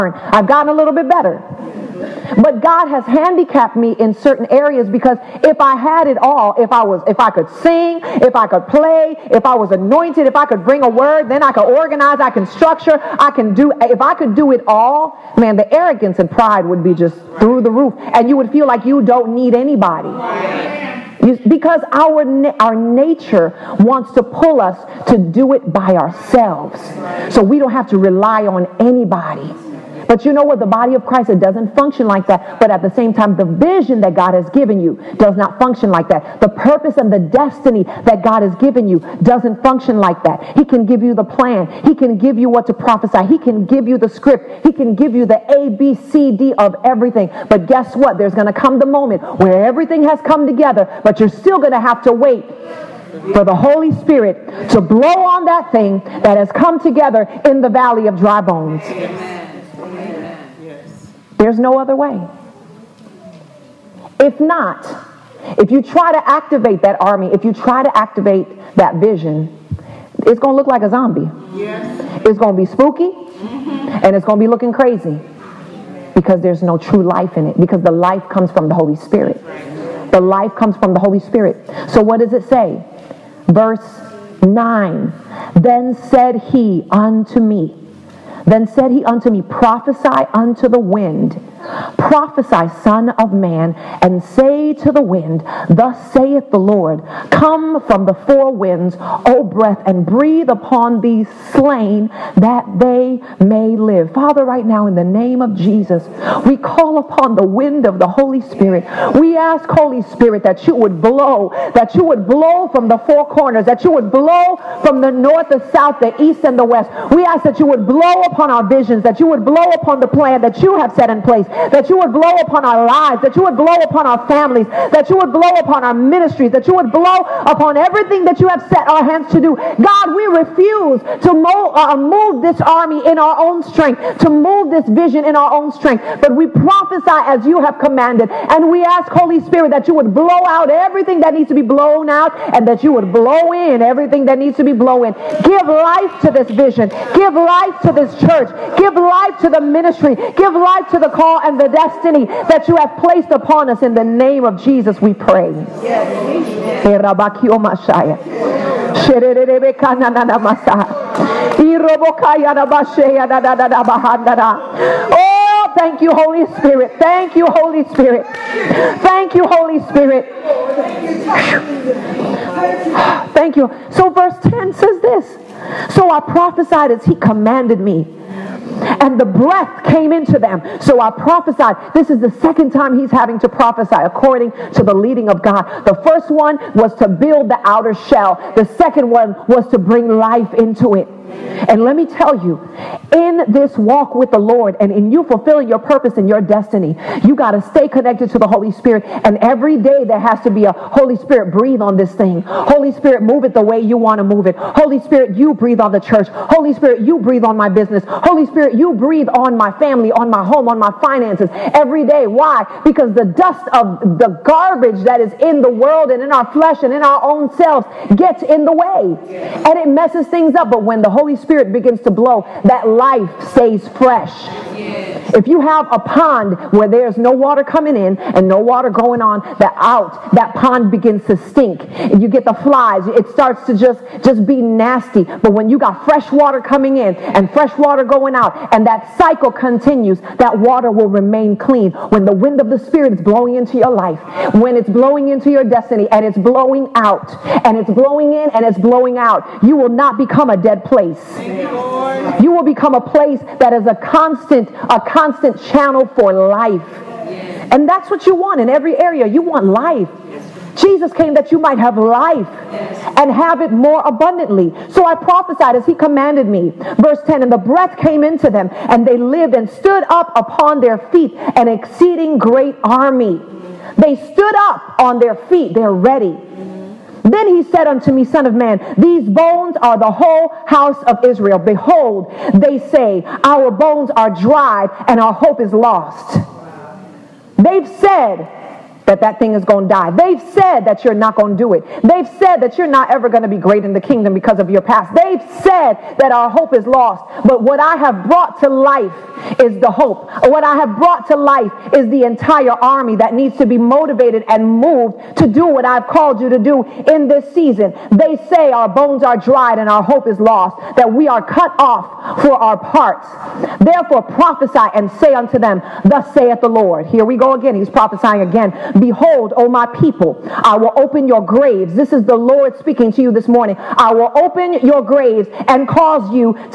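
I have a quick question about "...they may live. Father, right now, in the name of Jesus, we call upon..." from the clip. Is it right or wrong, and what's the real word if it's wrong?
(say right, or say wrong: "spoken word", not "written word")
right.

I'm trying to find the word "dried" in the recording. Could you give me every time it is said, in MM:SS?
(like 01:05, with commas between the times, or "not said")
04:44, 05:09.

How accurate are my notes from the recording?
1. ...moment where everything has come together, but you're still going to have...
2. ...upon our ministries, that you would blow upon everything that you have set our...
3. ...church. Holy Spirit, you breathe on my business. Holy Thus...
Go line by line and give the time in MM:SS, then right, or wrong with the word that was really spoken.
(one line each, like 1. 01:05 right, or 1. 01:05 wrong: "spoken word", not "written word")
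1. 00:48 right
2. 02:05 right
3. 03:25 wrong: "Spirit", not "Thus".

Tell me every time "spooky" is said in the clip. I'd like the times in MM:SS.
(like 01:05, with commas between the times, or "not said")
01:12.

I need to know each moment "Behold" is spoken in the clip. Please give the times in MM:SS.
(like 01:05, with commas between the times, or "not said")
04:41, 05:18.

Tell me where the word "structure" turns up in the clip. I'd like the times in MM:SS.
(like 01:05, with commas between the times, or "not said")
00:12.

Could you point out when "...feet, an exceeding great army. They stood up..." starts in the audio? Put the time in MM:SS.
04:31.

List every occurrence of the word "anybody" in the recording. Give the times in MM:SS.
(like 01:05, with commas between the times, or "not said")
00:19, 00:28.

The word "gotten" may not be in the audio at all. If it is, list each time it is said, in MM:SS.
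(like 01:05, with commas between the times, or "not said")
00:00.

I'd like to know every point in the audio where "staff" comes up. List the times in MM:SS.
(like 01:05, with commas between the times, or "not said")
not said.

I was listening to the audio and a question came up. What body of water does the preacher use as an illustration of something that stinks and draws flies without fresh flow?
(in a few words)
A pond.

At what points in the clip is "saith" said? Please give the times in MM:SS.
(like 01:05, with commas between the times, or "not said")
01:36, 05:16.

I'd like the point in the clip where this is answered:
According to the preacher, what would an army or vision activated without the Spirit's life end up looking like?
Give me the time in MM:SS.
01:10.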